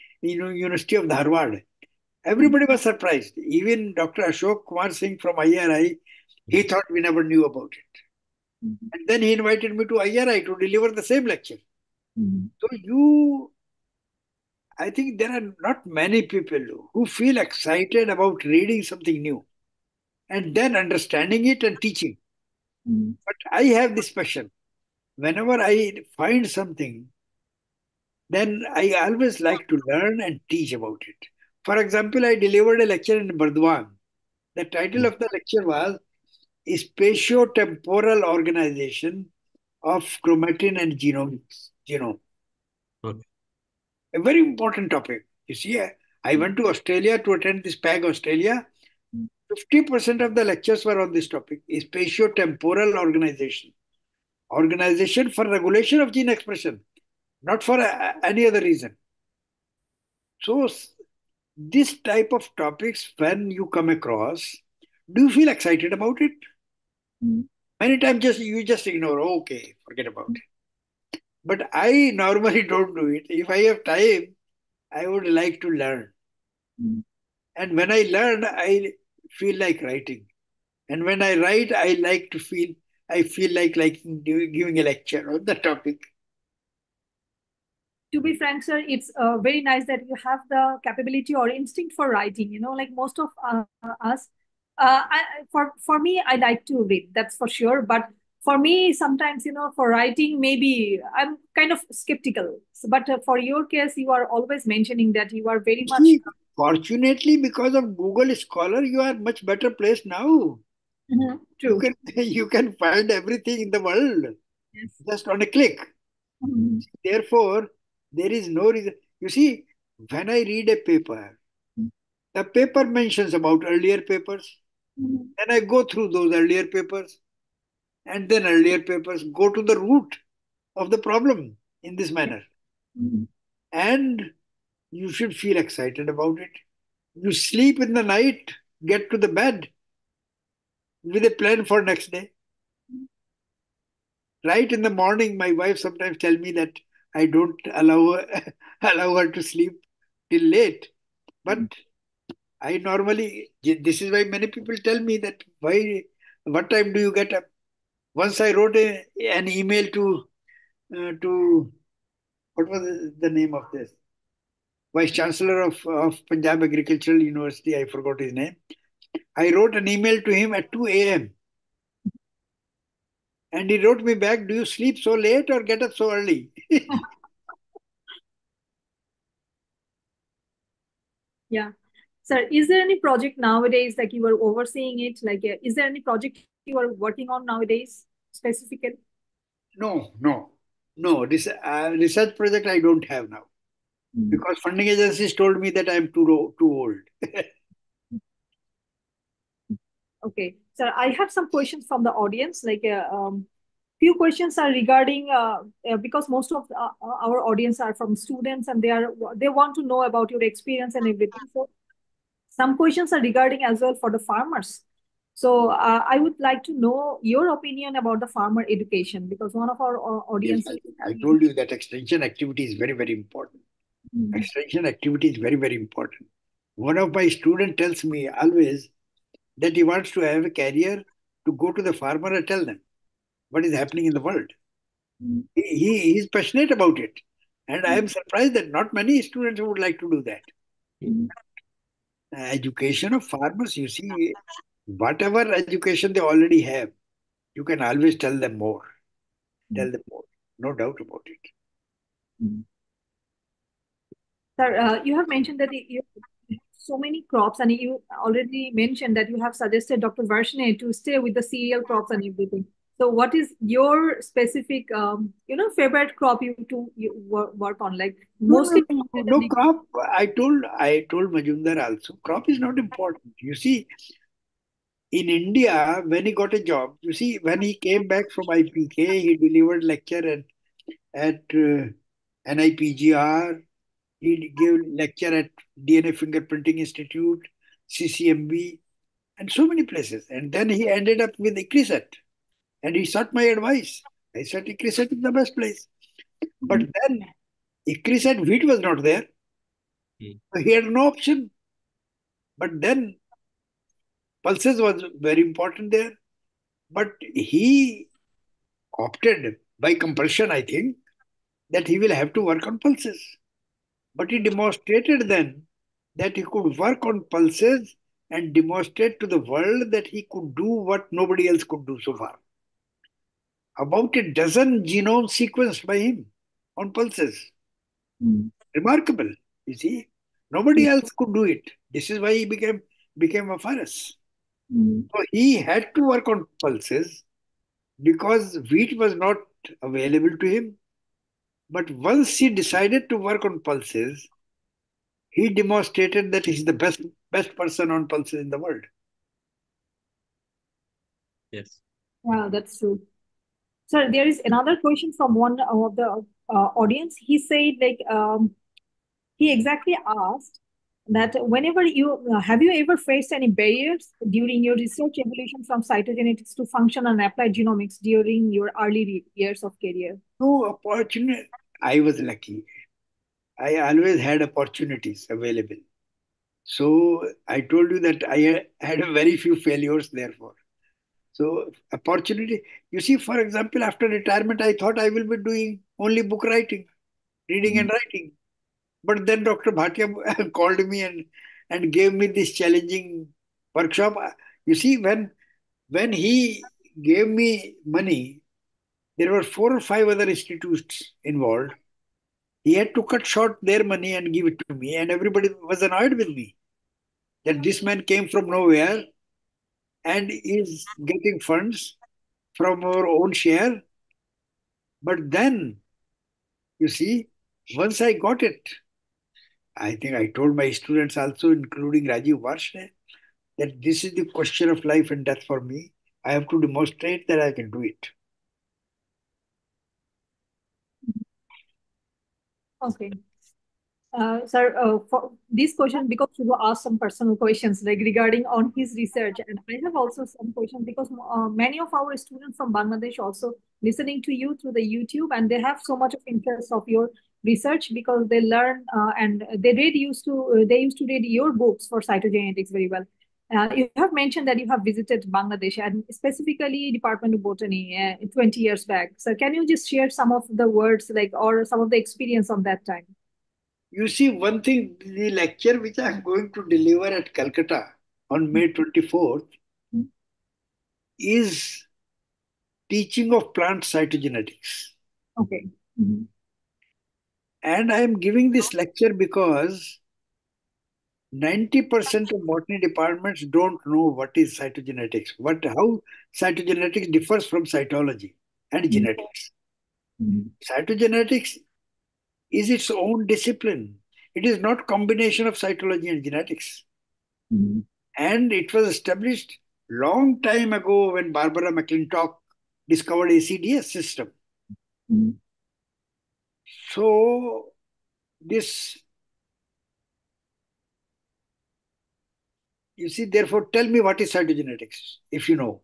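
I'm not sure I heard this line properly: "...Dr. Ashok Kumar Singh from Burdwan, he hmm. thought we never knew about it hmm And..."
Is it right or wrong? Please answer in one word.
wrong.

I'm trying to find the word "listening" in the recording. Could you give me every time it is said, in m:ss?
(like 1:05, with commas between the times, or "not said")
7:23.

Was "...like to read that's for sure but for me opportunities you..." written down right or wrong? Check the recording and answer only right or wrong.
wrong.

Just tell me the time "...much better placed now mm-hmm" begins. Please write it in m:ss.
1:49.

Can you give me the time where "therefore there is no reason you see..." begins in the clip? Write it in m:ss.
1:57.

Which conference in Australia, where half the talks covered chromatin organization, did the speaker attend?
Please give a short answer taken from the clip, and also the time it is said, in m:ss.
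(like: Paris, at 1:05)
PAG Australia, at 0:47.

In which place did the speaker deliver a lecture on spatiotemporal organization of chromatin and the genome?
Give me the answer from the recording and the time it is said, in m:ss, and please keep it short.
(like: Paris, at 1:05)
Burdwan, at 0:33.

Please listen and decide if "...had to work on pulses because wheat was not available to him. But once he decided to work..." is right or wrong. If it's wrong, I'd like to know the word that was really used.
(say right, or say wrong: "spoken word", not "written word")
right.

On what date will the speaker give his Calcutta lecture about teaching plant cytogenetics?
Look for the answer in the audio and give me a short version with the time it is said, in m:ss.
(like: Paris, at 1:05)
May 24, at 7:48.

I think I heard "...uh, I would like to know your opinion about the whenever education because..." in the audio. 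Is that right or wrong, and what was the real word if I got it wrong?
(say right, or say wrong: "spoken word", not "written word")
wrong: "farmer", not "whenever".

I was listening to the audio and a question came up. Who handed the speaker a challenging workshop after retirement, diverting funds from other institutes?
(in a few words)
Dr. Bhatia.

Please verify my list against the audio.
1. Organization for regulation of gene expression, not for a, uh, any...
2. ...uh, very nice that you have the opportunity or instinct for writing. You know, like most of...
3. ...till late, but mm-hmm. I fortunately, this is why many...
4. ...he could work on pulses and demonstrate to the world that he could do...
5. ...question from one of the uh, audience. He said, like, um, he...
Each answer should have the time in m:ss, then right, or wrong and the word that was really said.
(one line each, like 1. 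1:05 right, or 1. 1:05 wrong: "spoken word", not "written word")
1. 0:54 right
2. 1:29 wrong: "capability", not "opportunity"
3. 2:30 wrong: "normally", not "fortunately"
4. 5:16 right
5. 5:54 right.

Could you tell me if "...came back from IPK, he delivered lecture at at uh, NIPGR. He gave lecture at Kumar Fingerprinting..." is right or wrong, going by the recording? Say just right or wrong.
wrong.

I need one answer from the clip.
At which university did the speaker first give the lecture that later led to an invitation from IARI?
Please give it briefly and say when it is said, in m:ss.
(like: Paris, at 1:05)
University of Dharwad, at 0:00.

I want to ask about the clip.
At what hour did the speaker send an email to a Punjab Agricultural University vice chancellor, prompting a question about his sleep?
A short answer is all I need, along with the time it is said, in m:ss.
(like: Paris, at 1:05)
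2 a.m., at 2:50.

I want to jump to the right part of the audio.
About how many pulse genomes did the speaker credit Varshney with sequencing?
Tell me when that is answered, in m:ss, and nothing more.
5:23.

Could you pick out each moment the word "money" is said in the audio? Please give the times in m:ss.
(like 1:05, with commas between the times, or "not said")
6:37, 6:43.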